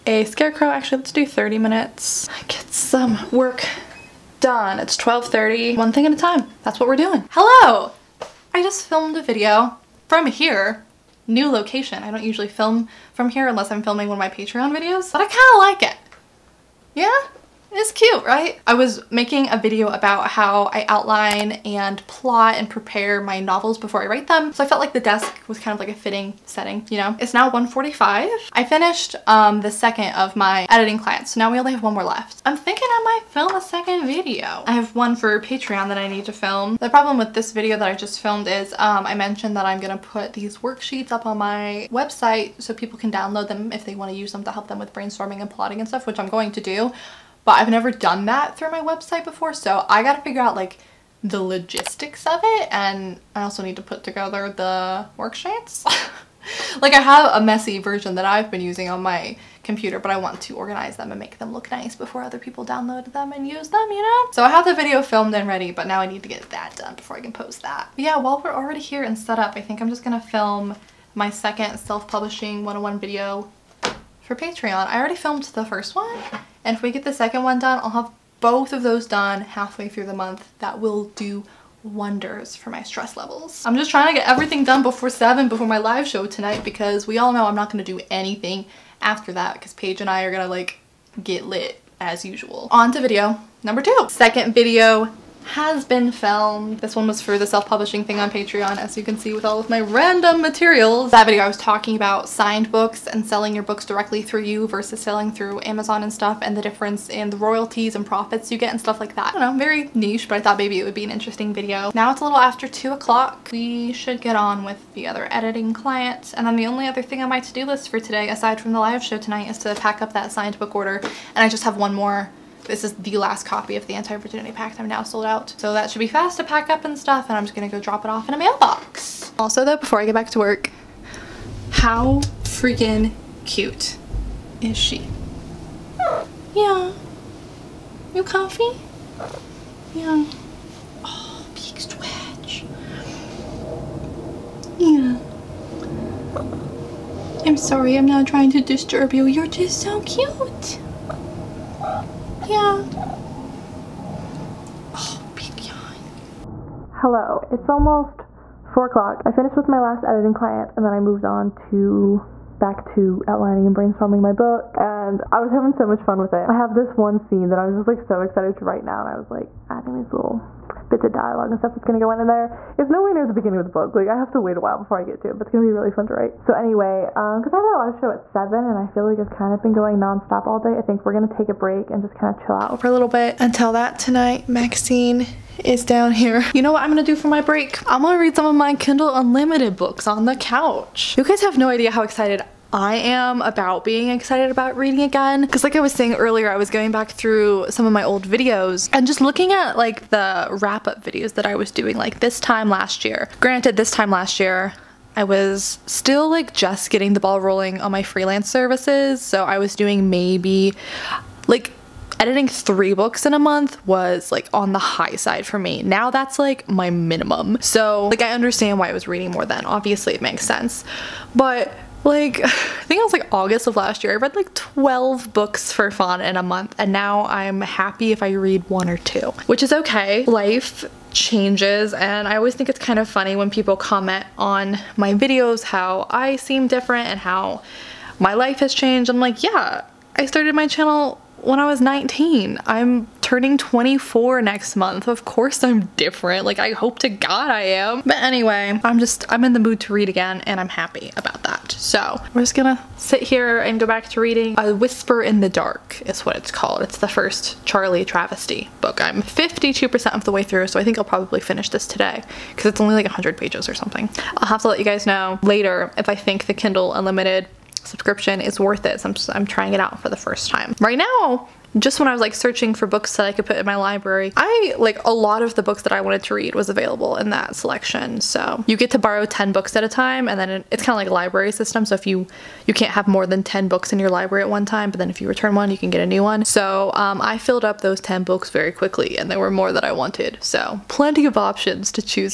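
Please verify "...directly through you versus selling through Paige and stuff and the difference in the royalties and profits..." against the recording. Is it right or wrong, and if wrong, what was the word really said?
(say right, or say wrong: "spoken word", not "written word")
wrong: "Amazon", not "Paige".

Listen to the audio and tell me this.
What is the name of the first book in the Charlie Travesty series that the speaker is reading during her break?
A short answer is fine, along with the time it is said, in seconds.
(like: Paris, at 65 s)
A Whisper in the Dark, at 254 s.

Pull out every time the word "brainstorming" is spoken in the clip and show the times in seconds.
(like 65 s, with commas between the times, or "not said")
44 s, 163 s.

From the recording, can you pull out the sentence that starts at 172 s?
It's nowhere near the beginning of the book.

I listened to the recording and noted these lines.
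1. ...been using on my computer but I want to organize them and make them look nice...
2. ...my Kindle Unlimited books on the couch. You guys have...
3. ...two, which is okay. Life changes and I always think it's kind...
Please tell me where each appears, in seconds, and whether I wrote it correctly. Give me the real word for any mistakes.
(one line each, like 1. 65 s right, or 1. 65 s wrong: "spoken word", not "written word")
1. 58 s right
2. 188 s right
3. 228 s right.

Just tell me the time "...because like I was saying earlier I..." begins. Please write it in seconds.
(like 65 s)
195 s.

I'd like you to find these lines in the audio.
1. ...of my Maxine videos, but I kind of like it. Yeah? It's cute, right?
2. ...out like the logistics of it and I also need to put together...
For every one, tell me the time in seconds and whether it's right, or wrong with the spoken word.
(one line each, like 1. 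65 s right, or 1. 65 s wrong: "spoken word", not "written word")
1. 14 s wrong: "Patreon", not "Maxine"
2. 50 s right.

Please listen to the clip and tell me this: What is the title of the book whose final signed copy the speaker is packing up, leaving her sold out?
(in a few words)
The Anti-Virginity Pact.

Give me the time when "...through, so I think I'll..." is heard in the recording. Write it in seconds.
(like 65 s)
260 s.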